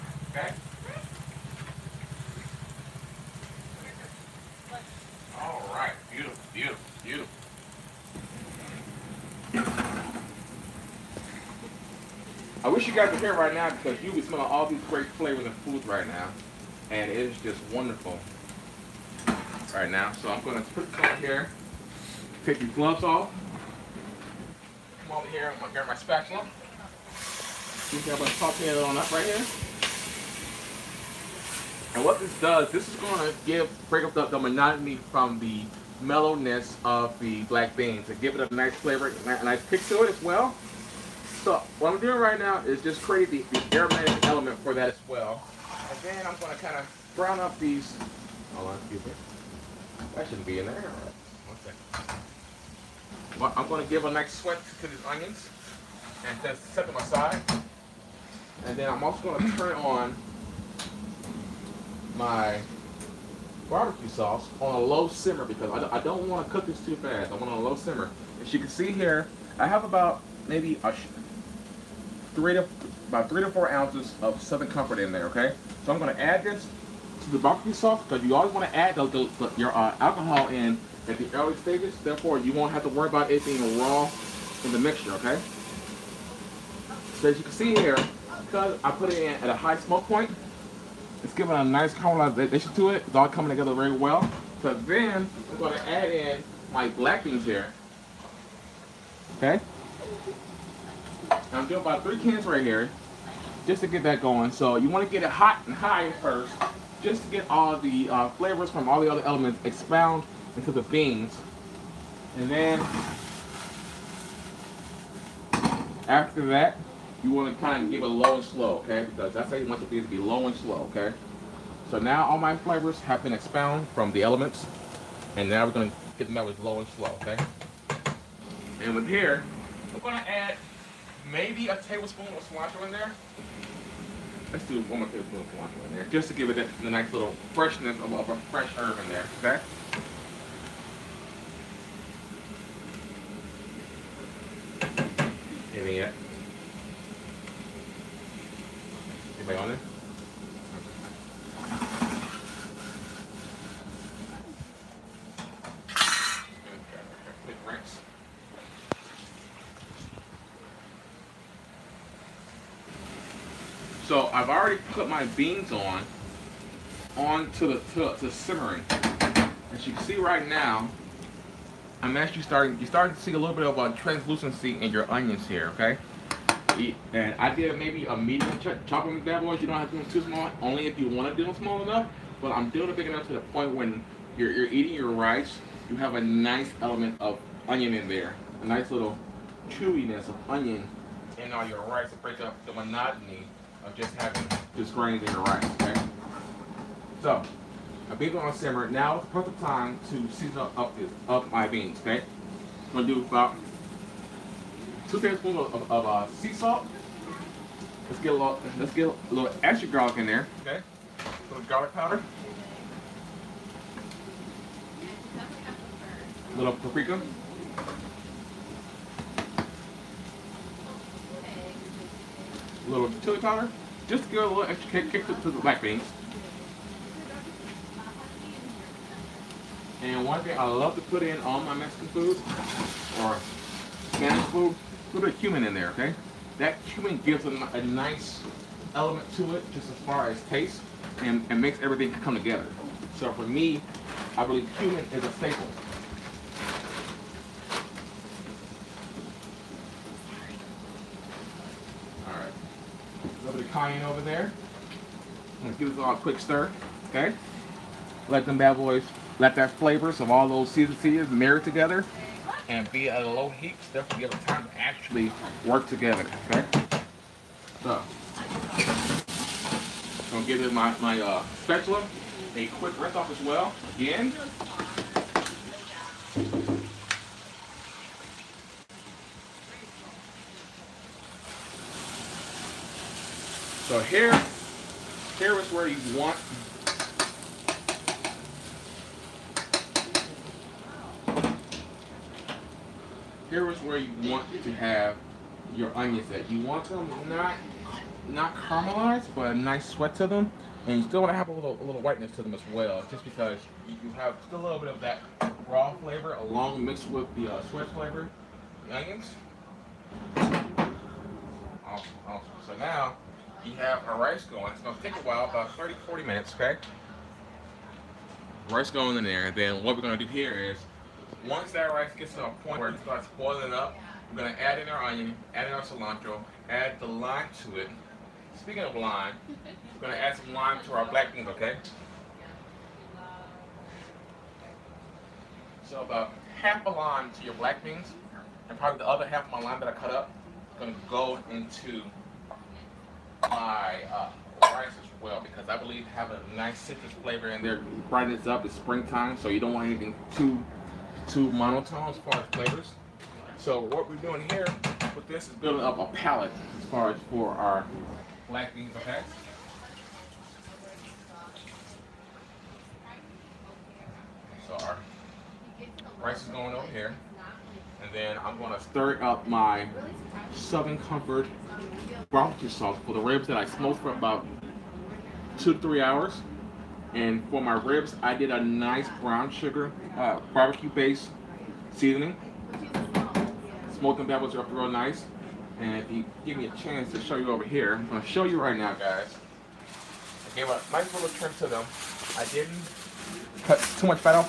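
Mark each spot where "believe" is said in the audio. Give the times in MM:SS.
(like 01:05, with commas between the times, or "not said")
04:04, 05:45.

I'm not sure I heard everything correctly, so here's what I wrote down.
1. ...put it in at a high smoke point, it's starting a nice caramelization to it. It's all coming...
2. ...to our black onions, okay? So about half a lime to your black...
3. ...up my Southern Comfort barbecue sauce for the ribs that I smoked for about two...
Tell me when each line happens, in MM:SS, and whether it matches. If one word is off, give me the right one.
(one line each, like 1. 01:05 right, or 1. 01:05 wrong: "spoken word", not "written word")
1. 01:28 wrong: "giving", not "starting"
2. 05:30 wrong: "beans", not "onions"
3. 06:09 right.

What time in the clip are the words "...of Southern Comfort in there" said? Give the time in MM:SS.
01:14.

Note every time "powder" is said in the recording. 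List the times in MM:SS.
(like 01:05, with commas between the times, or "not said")
03:31, 03:43.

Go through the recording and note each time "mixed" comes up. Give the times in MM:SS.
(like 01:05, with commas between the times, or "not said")
05:06.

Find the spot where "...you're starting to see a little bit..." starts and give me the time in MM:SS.
02:52.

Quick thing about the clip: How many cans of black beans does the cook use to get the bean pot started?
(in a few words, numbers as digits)
3.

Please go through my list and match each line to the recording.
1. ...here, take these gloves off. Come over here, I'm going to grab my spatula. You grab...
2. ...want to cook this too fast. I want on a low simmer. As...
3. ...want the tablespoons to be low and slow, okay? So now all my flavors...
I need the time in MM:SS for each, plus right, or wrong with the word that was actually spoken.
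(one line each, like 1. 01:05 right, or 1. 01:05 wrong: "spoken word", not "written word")
1. 00:21 right
2. 01:06 right
3. 01:59 wrong: "beans", not "tablespoons".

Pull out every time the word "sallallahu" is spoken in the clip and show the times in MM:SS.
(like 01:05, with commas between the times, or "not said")
not said.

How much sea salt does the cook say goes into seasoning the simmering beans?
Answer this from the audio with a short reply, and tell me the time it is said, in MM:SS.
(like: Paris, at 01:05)
2 tablespoons, at 03:25.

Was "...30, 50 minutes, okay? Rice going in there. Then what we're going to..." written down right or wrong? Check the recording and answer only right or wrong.
wrong.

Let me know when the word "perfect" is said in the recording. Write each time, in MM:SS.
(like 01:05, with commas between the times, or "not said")
03:19.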